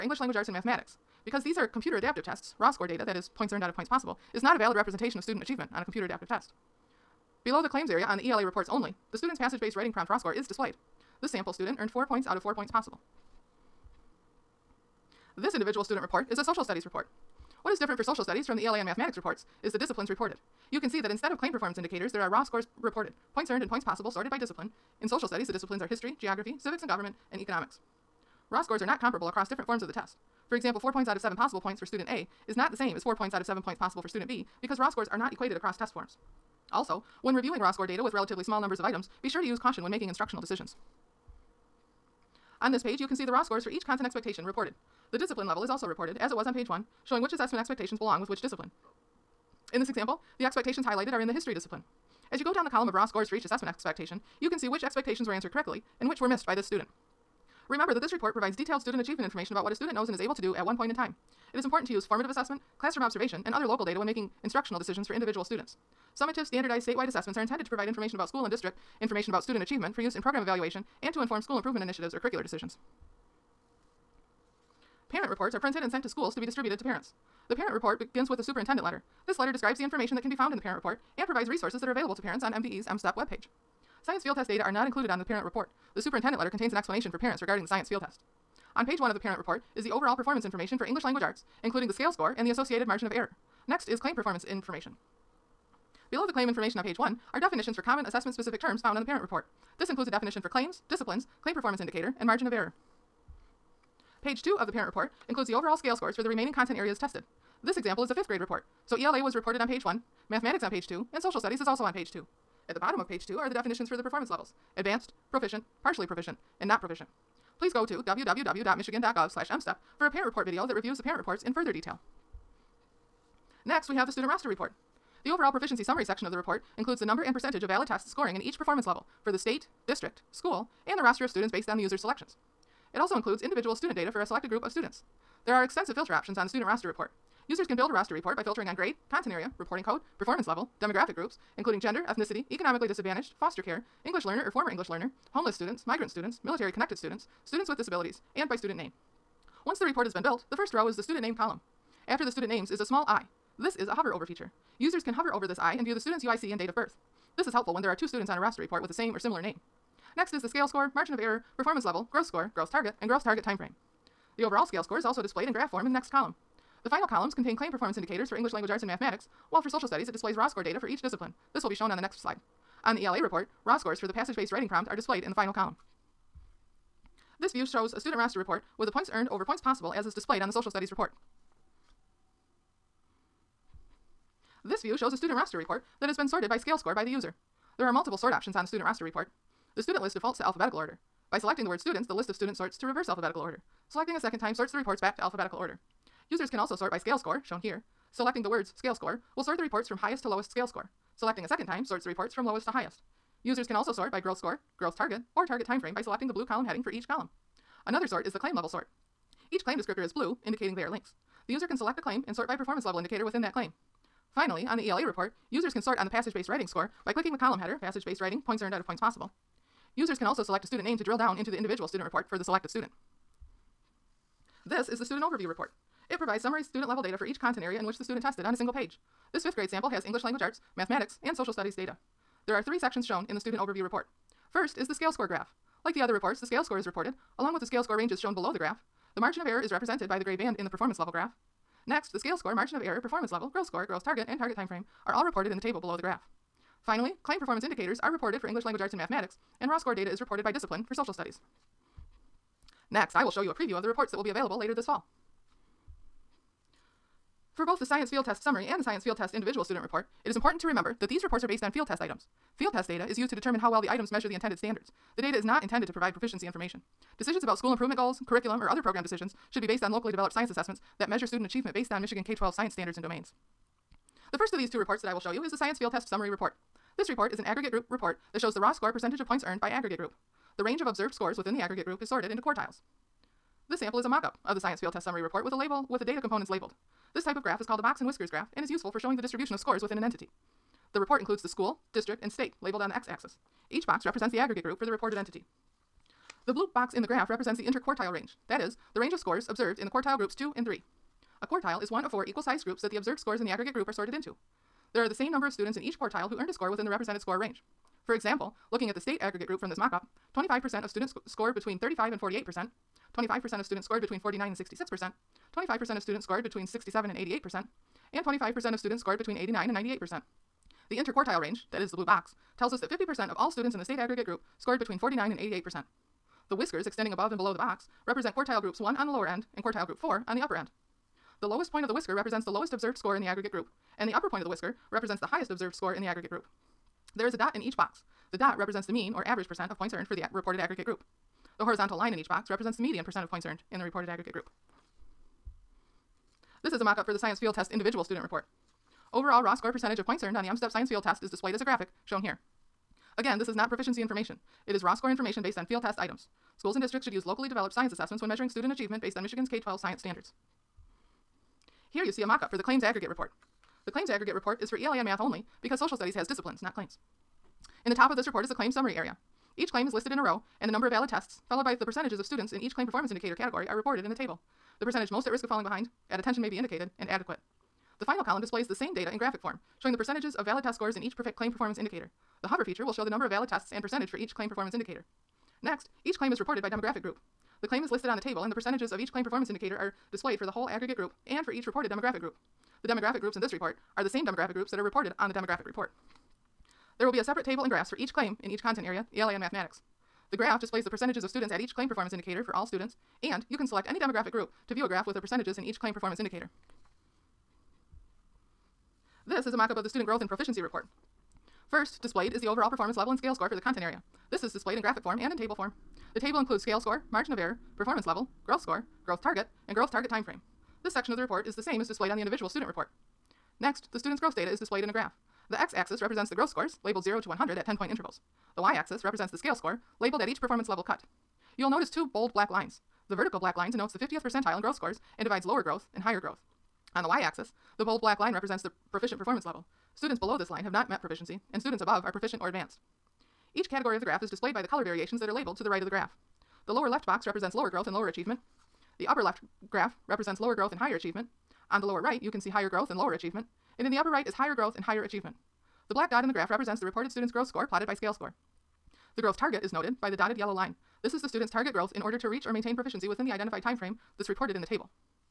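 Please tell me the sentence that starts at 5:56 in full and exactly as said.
Schools and districts should use locally developed science assessments when measuring student achievement based on Michigan's K 12 science standards.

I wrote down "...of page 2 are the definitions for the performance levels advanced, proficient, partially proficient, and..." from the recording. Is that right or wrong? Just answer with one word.
right.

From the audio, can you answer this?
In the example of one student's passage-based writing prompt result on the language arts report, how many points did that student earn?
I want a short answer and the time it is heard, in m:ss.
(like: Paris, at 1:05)
4 points out of 4, at 0:11.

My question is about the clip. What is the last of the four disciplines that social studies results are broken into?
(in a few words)
economics.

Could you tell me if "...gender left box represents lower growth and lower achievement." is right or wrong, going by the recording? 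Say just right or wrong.
wrong.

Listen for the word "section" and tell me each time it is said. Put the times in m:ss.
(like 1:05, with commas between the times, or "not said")
2:06, 3:52, 7:00.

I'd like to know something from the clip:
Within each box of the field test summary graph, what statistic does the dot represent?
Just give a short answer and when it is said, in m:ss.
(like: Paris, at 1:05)
mean, at 5:38.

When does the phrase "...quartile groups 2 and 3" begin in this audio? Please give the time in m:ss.
4:59.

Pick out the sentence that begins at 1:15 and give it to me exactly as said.
Parent reports are printed and sent to schools to be distributed to parents.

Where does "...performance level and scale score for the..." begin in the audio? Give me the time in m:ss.
6:52.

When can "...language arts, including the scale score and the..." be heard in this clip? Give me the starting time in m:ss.
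1:31.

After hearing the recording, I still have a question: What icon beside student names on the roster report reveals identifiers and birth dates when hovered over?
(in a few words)
a small i.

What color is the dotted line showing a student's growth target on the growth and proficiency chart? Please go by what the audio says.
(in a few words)
yellow.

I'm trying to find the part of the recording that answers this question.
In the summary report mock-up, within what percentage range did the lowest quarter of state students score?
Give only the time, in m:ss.
5:11.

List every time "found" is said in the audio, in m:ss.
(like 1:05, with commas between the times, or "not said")
1:20, 1:38.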